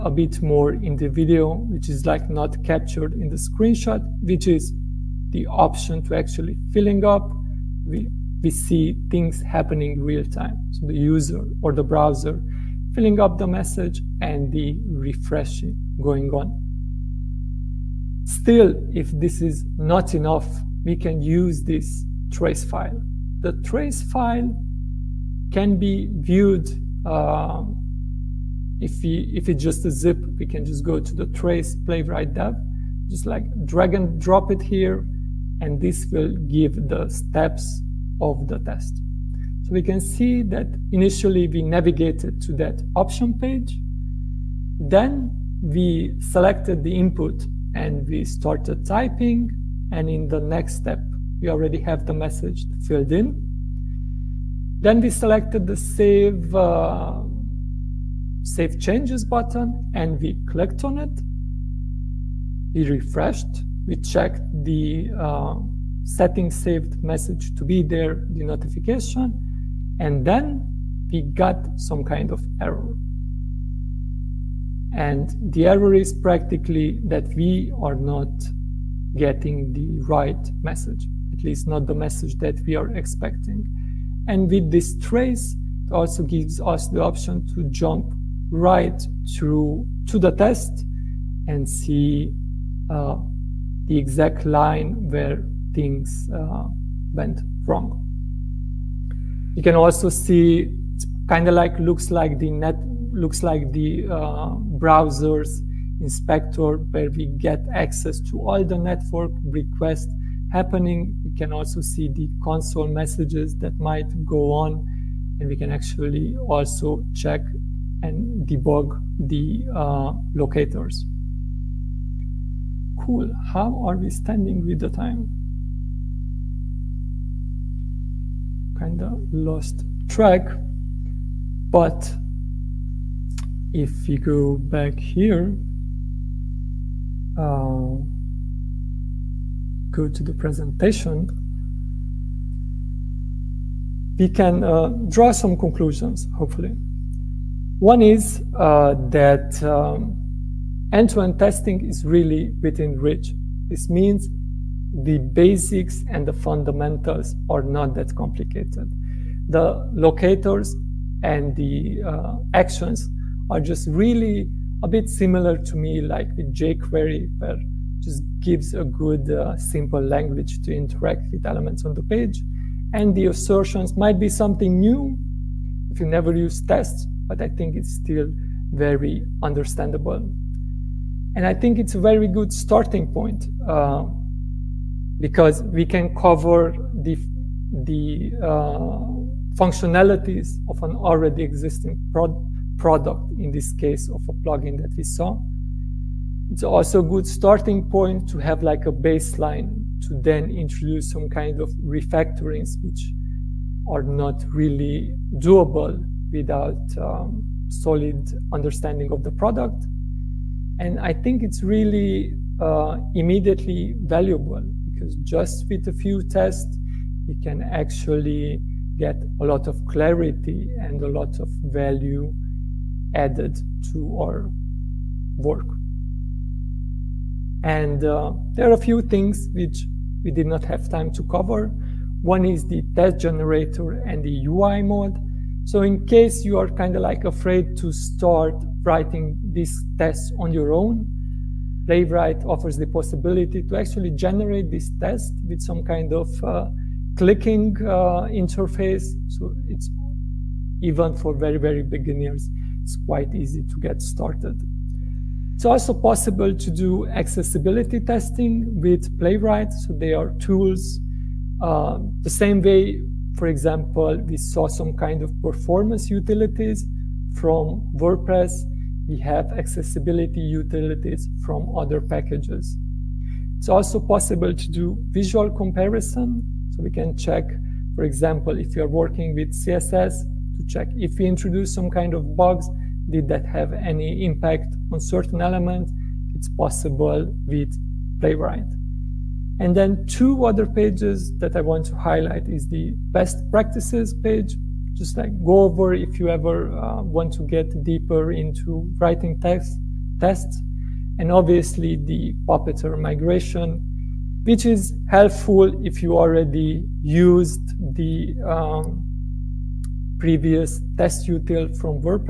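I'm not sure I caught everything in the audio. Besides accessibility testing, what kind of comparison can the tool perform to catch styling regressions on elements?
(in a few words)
Visual comparison.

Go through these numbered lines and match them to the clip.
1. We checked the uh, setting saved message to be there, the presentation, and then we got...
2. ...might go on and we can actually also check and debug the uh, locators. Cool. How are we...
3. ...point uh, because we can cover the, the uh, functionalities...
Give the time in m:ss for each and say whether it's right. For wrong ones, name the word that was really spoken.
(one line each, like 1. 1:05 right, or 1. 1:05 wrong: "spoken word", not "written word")
1. 1:03 wrong: "notification", not "presentation"
2. 1:53 right
3. 3:03 right.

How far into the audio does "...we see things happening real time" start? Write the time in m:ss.
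0:08.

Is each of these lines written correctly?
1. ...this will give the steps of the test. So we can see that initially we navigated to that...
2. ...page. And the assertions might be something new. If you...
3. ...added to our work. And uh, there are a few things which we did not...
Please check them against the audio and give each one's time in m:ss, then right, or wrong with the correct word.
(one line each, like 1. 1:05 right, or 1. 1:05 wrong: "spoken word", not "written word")
1. 0:35 right
2. 2:52 right
3. 3:43 right.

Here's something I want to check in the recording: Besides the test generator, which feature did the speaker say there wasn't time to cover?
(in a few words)
UI mode.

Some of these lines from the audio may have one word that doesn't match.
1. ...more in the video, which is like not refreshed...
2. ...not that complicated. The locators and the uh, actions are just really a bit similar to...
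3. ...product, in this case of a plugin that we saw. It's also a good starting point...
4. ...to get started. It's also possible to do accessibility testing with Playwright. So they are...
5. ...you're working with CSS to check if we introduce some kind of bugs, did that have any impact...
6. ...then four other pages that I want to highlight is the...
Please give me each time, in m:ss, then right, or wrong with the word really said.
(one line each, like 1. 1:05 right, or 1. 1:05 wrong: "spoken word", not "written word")
1. 0:00 wrong: "captured", not "refreshed"
2. 2:37 right
3. 3:12 right
4. 4:13 right
5. 4:38 right
6. 4:49 wrong: "two", not "four".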